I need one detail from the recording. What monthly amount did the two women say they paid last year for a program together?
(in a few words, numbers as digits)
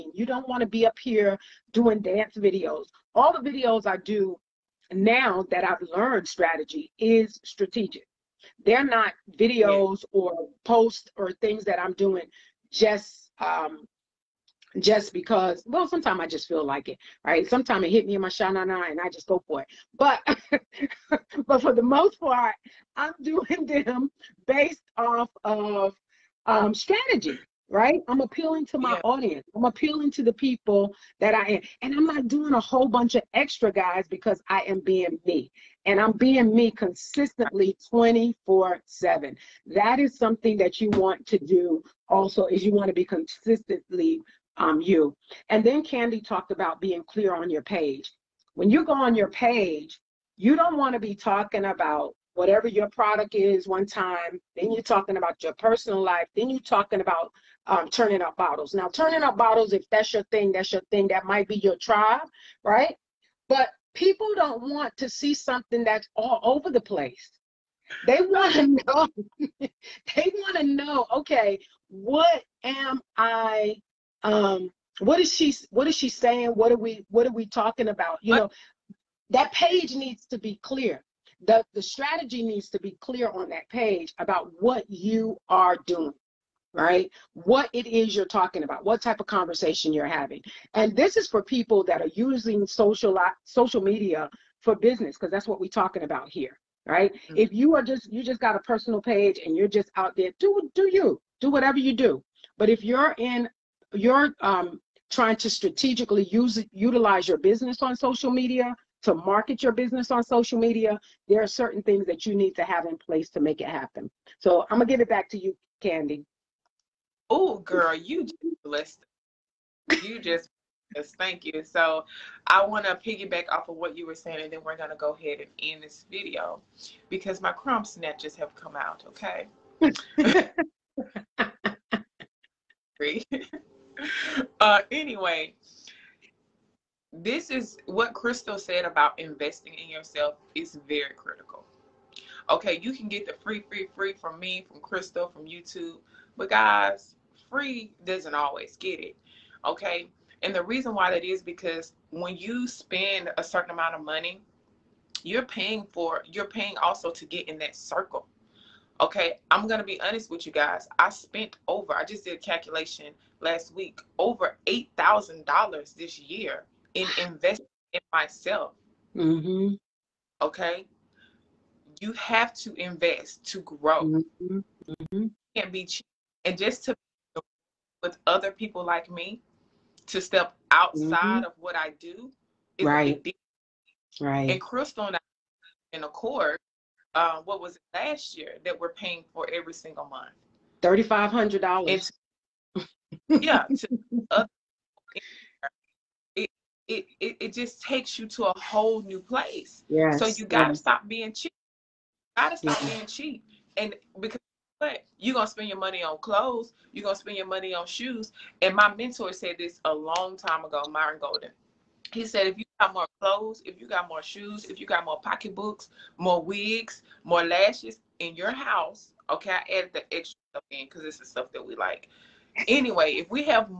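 $3,500.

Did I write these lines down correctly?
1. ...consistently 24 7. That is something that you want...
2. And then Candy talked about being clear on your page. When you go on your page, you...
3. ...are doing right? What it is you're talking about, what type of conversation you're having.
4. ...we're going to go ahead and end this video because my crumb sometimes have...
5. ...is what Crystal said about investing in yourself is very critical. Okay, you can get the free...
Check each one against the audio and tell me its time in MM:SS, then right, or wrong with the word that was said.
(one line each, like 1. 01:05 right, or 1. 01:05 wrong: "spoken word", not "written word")
1. 00:36 right
2. 00:45 right
3. 01:25 right
4. 02:04 wrong: "snatches", not "sometimes"
5. 02:17 right.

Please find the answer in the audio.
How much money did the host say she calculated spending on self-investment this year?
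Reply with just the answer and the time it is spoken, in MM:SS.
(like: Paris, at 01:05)
over $8,000, at 02:44.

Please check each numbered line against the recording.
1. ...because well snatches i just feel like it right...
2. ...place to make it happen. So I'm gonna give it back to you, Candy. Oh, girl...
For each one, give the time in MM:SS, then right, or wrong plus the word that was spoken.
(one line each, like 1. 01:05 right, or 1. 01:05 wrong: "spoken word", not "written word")
1. 00:15 wrong: "sometimes", not "snatches"
2. 01:52 right.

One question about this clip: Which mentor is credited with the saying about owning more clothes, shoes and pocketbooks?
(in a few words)
Myron Golden.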